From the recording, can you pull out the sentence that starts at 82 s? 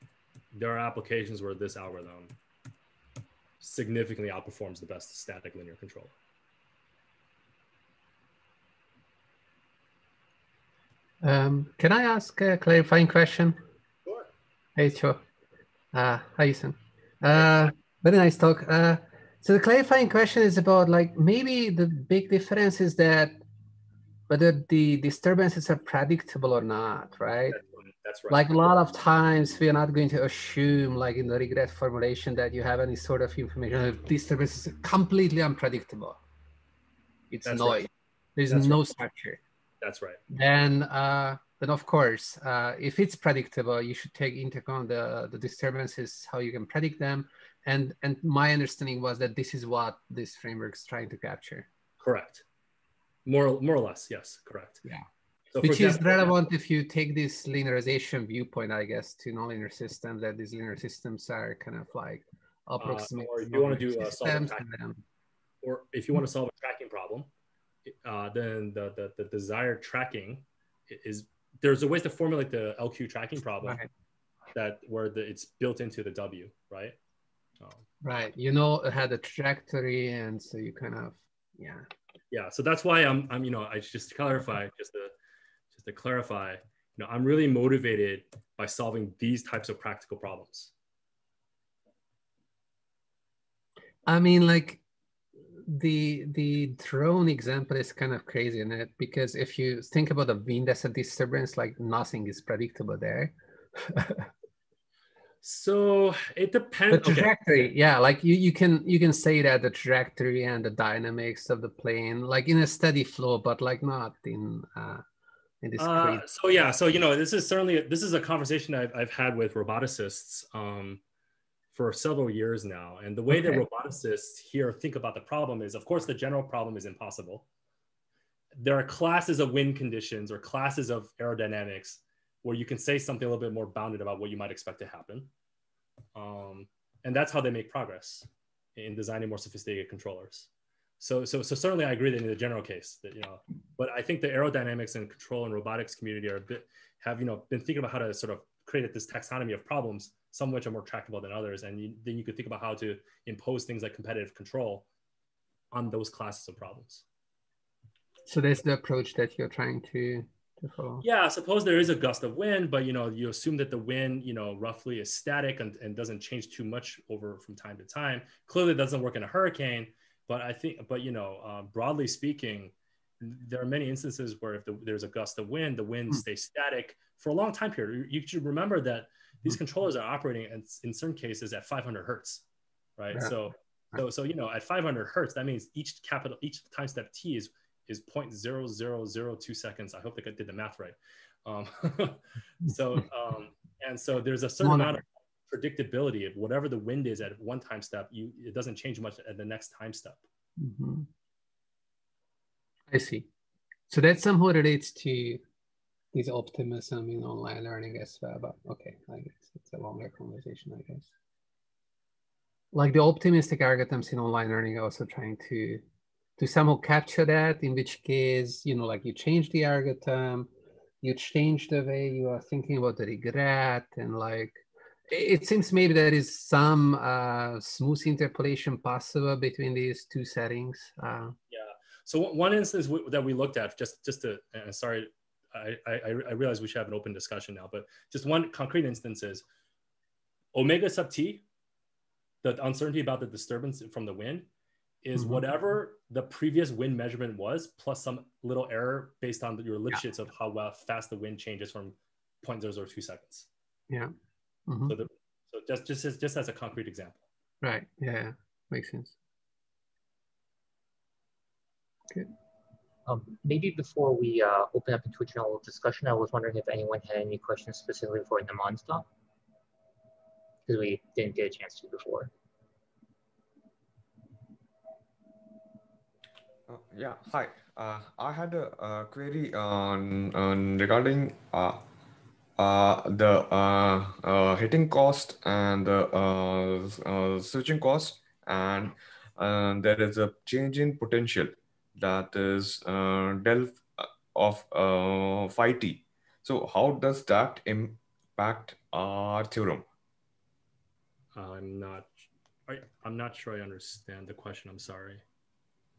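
Yeah, so that's why I'm I'm you know I just to clarify mm-hmm.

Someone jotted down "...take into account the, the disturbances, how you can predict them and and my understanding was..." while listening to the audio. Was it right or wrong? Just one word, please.
right.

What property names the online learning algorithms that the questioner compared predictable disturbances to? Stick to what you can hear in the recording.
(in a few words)
Optimism.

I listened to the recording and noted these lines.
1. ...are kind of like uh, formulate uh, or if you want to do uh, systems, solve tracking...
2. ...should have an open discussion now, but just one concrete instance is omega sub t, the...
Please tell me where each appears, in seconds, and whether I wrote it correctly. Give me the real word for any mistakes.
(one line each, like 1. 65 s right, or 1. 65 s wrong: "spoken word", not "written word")
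1. 61 s wrong: "approximate", not "formulate"
2. 236 s right.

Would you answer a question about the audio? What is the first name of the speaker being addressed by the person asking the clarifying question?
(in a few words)
Ethan.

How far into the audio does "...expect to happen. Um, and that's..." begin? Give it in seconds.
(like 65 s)
134 s.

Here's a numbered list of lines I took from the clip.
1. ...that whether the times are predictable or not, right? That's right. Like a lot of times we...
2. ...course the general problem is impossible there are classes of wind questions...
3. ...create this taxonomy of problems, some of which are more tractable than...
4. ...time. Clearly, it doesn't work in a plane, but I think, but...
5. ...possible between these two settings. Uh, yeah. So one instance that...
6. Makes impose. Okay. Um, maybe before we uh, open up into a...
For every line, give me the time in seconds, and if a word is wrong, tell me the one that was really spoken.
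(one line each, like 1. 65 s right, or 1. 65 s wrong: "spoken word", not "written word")
1. 22 s wrong: "disturbances", not "times"
2. 125 s wrong: "conditions", not "questions"
3. 148 s right
4. 167 s wrong: "hurricane", not "plane"
5. 228 s right
6. 258 s wrong: "sense", not "impose".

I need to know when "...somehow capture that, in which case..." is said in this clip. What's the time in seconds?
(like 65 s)
216 s.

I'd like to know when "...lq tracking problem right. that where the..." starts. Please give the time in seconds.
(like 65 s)
72 s.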